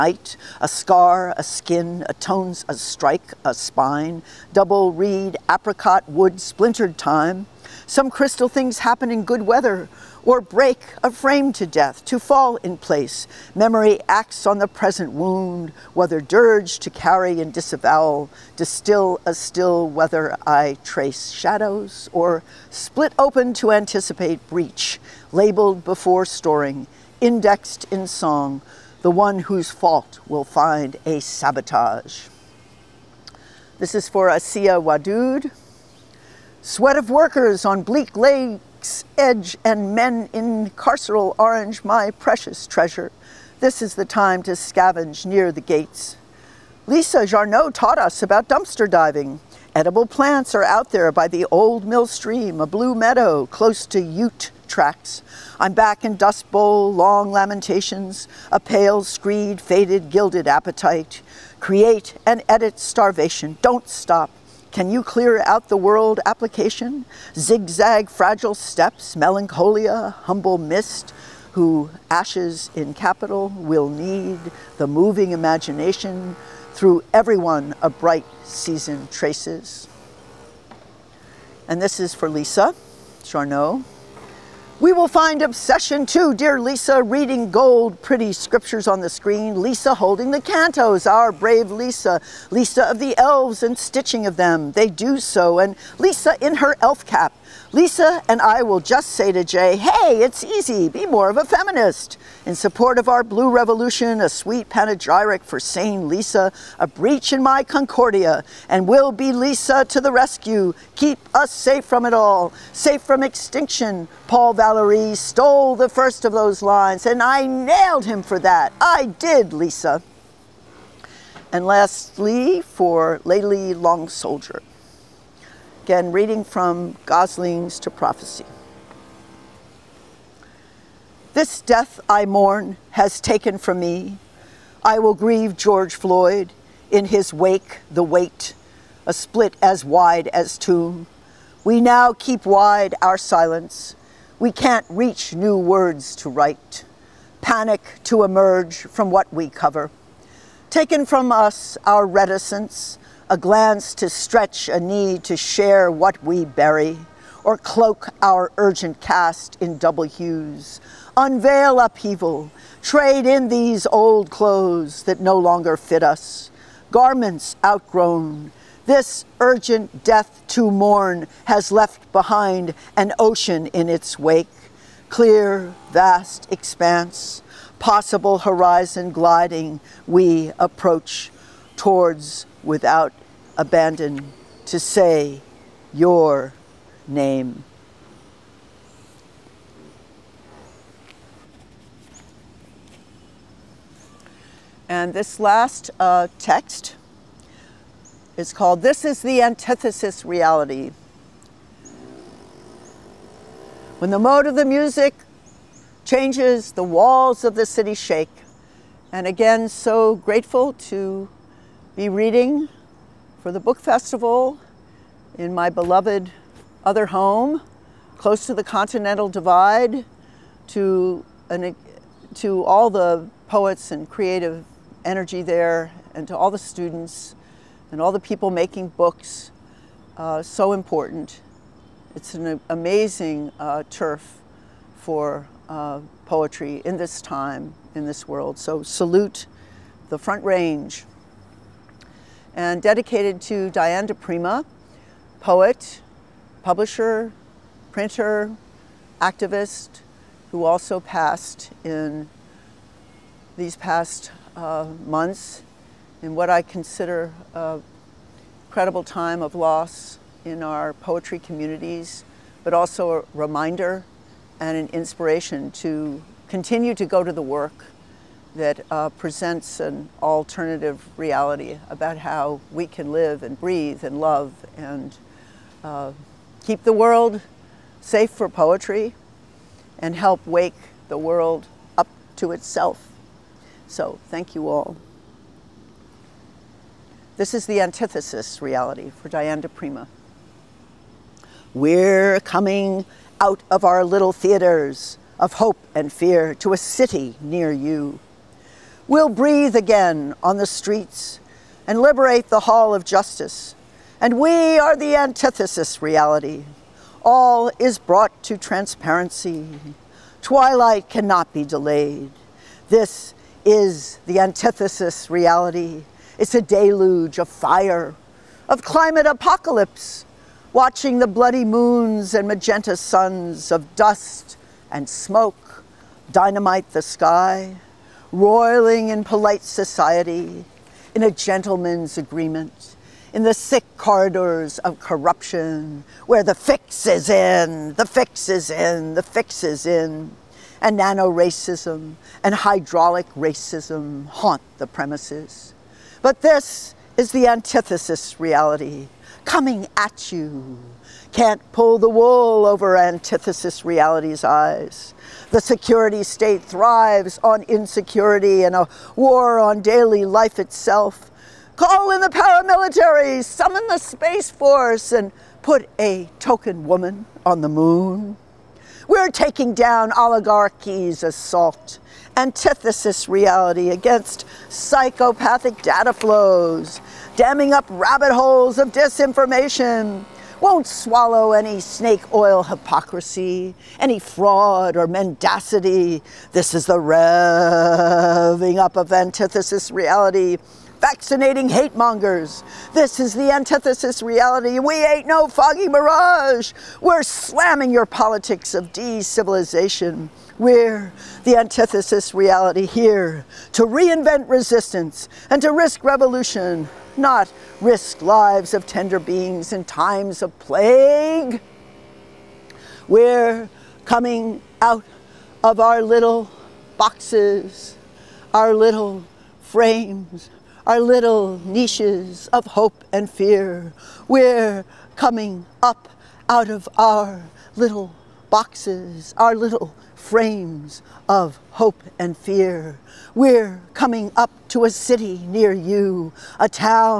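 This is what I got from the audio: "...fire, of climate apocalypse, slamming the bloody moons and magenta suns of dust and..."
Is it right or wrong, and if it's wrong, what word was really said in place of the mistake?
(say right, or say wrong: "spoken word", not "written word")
wrong: "watching", not "slamming".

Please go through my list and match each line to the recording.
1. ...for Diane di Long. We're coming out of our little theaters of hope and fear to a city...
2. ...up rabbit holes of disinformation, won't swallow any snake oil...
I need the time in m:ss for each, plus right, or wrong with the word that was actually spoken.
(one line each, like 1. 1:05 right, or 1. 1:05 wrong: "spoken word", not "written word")
1. 4:49 wrong: "Prima", not "Long"
2. 6:17 right.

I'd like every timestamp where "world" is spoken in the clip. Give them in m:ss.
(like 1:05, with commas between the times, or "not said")
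1:05, 3:58, 4:36, 4:41.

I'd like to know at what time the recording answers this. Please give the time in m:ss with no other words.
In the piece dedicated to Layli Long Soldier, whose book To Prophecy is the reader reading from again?
2:07.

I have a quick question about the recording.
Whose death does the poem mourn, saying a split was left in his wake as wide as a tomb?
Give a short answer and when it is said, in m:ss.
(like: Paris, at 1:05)
George Floyd, at 2:15.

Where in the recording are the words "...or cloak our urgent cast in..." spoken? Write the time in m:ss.
2:37.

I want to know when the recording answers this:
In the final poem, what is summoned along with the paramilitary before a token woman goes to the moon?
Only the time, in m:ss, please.
6:03.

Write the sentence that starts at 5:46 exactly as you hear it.
But this is the antithesis reality coming at you.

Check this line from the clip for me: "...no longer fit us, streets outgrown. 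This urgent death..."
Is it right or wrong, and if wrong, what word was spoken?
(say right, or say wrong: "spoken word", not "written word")
wrong: "garments", not "streets".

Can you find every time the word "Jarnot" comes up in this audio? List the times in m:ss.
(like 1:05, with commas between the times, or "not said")
0:47, 1:23.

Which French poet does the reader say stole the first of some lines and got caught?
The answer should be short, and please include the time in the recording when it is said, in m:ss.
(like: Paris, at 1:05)
Paul Valery, at 1:54.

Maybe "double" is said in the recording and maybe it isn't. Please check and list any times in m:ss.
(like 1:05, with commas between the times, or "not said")
0:04, 2:39.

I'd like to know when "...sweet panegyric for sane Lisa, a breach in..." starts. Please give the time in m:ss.
1:44.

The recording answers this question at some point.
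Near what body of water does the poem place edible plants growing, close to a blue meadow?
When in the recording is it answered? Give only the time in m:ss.
0:51.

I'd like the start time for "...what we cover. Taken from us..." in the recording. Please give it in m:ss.
2:29.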